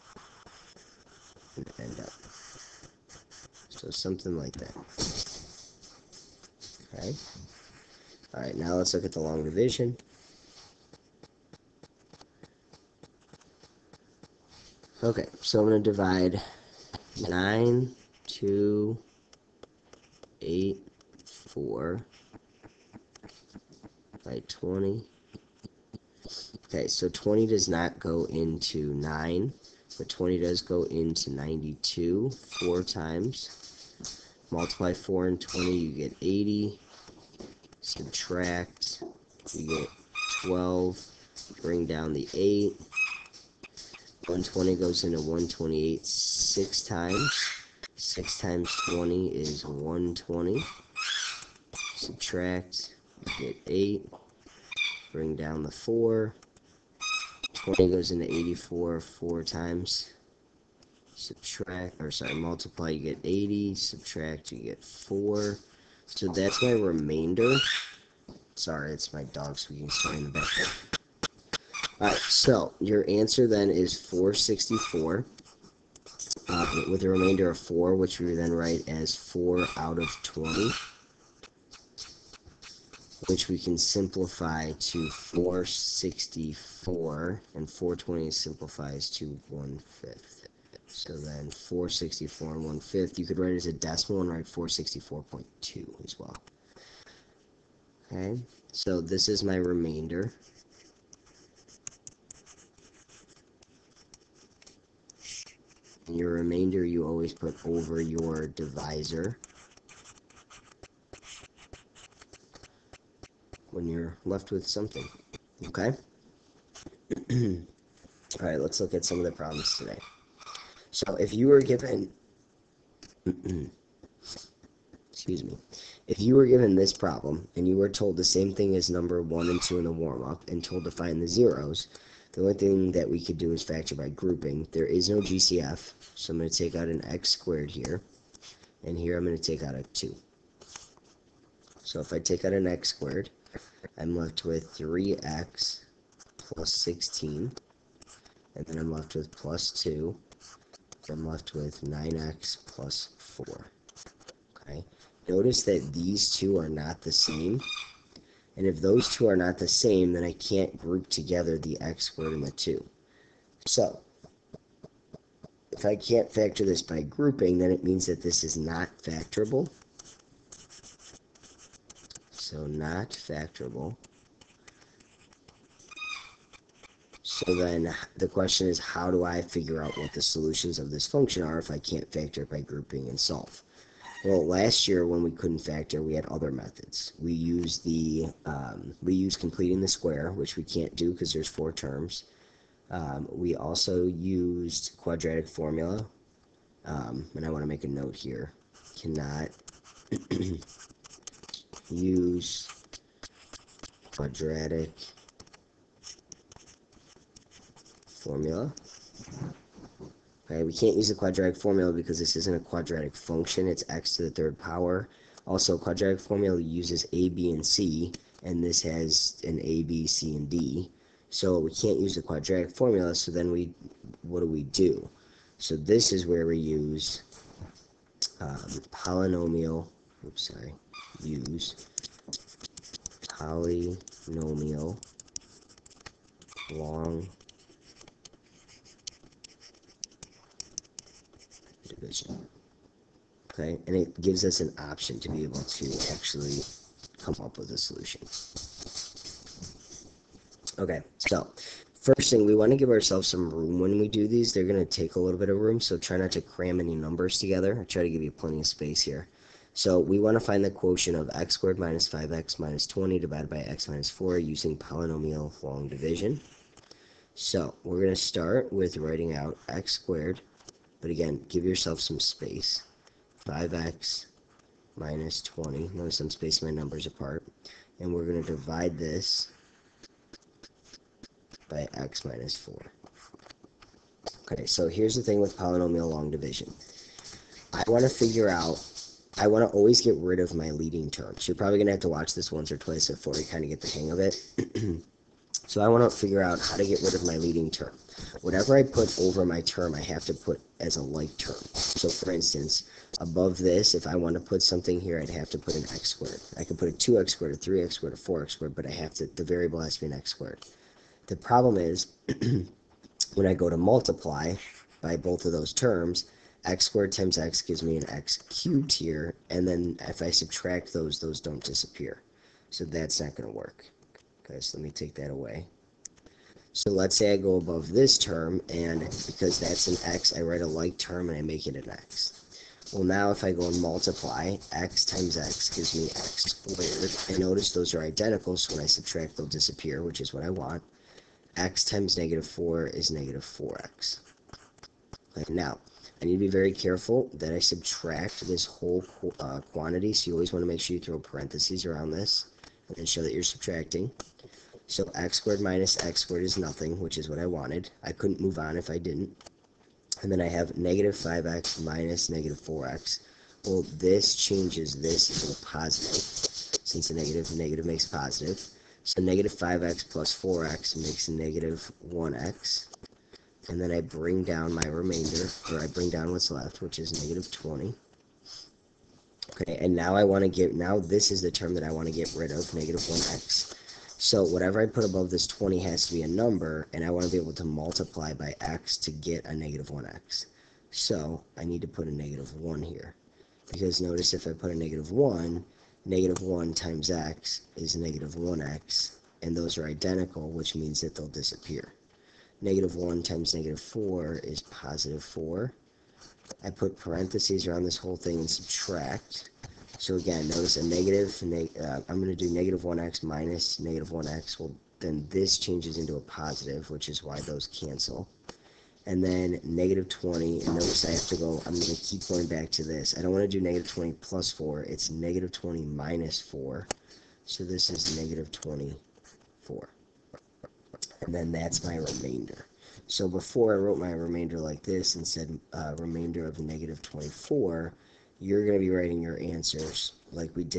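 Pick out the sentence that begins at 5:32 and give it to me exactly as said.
Well, now if I go and multiply, x times x gives me x squared.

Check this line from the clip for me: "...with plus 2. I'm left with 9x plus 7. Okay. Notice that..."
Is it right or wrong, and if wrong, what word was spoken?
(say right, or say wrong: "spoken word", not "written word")
wrong: "4", not "7".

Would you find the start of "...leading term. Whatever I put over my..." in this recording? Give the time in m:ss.
4:57.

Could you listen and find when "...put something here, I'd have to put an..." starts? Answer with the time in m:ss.
5:04.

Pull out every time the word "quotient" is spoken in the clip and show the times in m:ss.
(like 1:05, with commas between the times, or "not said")
4:20.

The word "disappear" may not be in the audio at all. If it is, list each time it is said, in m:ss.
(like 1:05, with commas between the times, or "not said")
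5:21, 5:39, 6:41.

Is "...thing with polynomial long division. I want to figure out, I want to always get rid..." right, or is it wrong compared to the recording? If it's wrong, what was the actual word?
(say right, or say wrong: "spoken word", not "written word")
right.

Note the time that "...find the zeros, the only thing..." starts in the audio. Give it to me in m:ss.
2:10.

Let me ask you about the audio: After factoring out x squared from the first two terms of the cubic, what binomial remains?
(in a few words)
3x + 16.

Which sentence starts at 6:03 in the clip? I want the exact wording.
Well, this changes this into a positive, since a negative, negative makes positive.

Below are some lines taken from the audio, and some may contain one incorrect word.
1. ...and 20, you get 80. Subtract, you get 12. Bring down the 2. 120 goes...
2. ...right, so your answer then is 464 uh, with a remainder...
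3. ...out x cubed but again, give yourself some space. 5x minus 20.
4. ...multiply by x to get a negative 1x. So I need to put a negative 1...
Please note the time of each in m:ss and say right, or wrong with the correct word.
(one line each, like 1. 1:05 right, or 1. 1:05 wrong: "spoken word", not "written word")
1. 0:35 wrong: "8", not "2"
2. 1:12 right
3. 4:29 wrong: "squared", not "cubed"
4. 6:27 right.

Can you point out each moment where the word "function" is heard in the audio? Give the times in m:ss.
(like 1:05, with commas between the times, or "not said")
3:01, 3:33.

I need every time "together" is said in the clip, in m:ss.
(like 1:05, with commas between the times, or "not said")
2:41, 4:17.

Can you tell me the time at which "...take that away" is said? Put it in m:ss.
5:24.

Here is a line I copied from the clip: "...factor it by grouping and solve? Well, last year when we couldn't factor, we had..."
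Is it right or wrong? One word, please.
right.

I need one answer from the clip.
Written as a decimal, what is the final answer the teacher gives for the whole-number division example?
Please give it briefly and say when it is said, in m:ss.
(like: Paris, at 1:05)
464.2, at 1:34.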